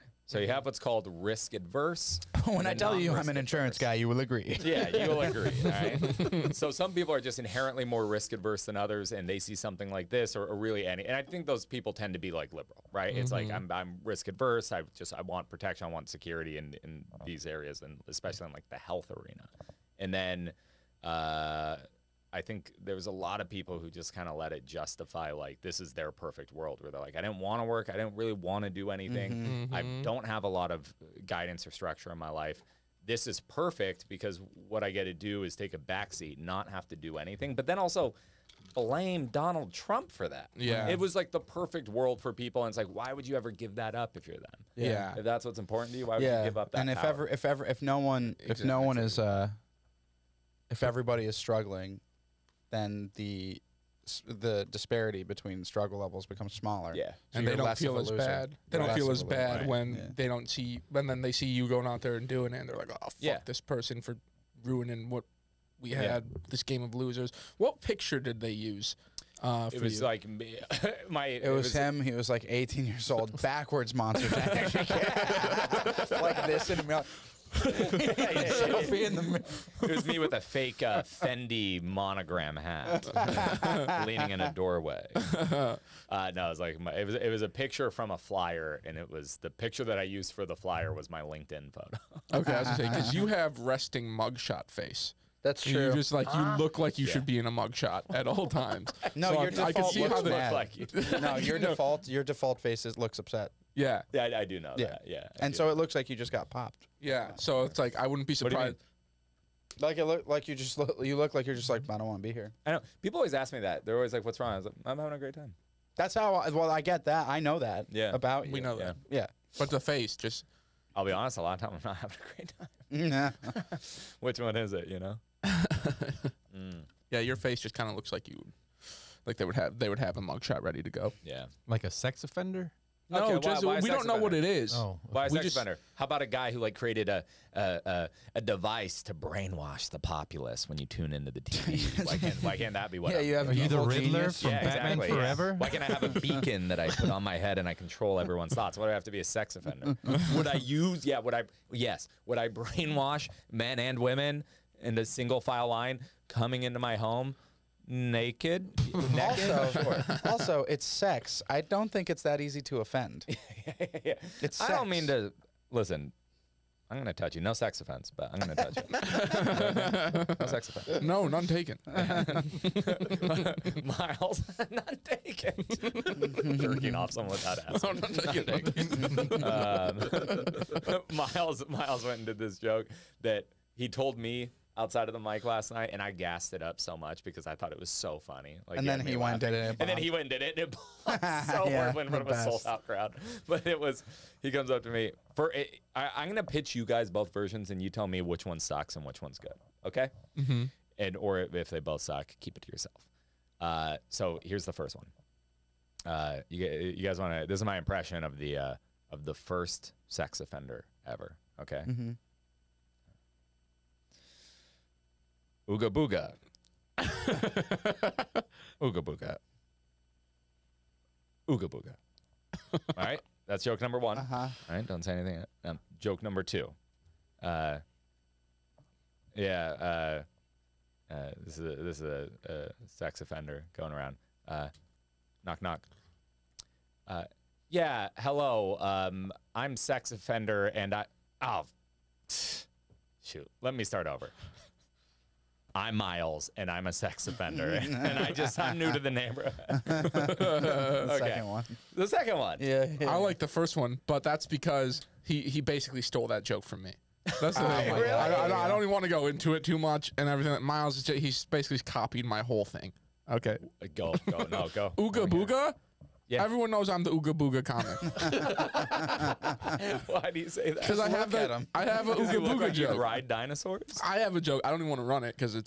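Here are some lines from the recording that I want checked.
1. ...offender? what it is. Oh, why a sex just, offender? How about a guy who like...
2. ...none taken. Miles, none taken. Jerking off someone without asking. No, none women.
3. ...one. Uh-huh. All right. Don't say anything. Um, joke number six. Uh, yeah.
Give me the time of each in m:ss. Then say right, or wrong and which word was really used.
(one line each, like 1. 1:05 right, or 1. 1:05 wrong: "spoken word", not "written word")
1. 2:14 right
2. 2:51 wrong: "taken", not "women"
3. 3:43 wrong: "two", not "six".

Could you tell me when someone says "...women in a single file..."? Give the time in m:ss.
2:33.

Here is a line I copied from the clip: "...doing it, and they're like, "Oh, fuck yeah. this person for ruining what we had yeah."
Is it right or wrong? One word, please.
right.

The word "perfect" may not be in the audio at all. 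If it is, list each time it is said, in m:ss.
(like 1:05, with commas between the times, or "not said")
0:26, 0:33, 0:41.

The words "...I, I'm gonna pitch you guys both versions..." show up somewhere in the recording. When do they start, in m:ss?
3:15.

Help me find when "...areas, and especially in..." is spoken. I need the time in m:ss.
0:17.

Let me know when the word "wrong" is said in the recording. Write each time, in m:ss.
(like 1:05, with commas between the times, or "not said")
1:54.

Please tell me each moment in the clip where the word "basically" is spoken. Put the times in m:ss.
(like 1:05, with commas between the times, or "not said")
4:15, 4:21.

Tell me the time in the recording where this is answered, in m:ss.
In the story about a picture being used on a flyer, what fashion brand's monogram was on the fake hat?
1:21.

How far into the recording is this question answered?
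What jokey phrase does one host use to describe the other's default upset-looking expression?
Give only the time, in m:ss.
1:33.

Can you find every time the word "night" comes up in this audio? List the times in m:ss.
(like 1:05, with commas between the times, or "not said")
3:05.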